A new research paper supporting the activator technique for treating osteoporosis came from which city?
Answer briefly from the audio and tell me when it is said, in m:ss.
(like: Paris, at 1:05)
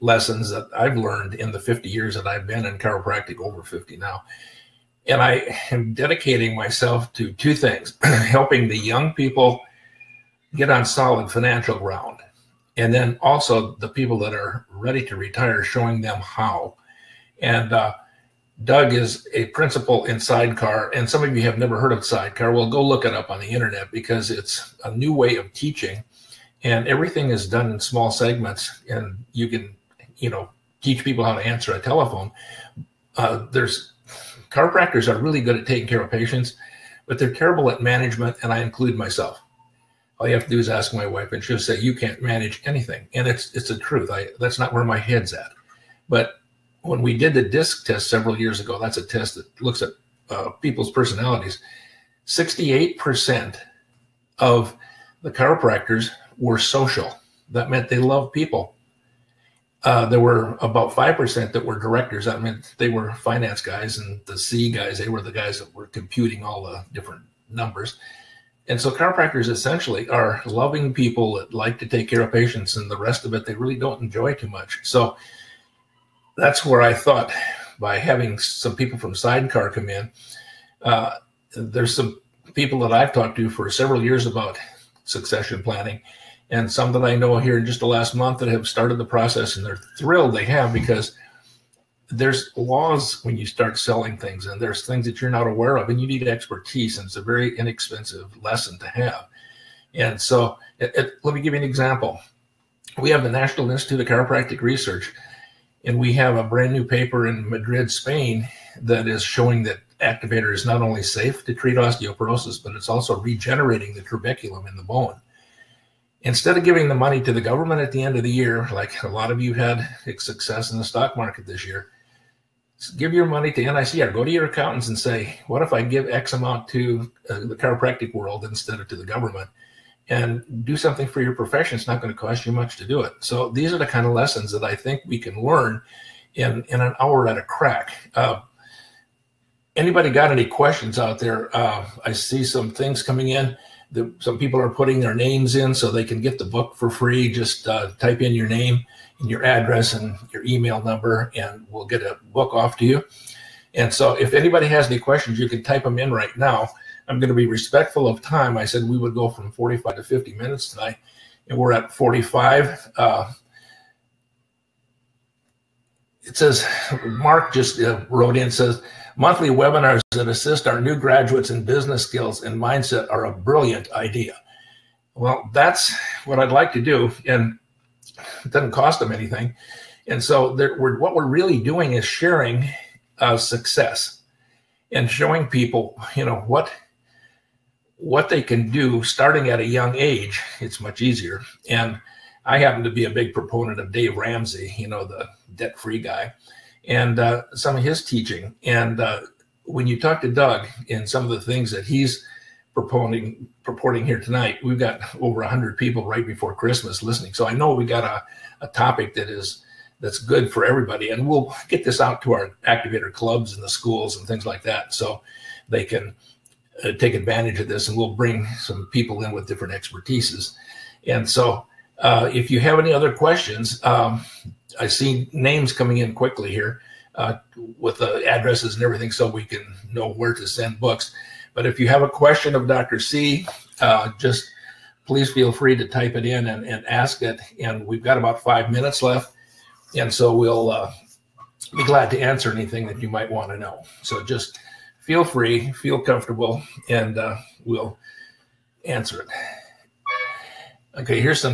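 Madrid, Spain, at 1:47.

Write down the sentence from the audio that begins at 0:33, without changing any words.
Uh, there's chiropractors are really good at taking care of patients, but they're terrible at management, and I include myself.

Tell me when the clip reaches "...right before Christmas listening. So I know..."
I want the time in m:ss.
3:26.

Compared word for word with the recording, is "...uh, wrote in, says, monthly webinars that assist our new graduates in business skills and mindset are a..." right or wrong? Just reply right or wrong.
right.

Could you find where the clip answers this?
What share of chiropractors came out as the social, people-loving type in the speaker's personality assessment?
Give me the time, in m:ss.
0:52.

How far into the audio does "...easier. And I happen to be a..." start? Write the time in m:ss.
3:11.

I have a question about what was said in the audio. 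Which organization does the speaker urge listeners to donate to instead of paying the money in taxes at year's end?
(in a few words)
NICR.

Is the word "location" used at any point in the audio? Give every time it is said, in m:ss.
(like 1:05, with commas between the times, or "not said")
not said.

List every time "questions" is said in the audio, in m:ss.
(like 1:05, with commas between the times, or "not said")
2:20, 2:34, 3:43, 3:52.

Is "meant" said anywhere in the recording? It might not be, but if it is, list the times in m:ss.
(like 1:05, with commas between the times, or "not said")
0:57, 1:02.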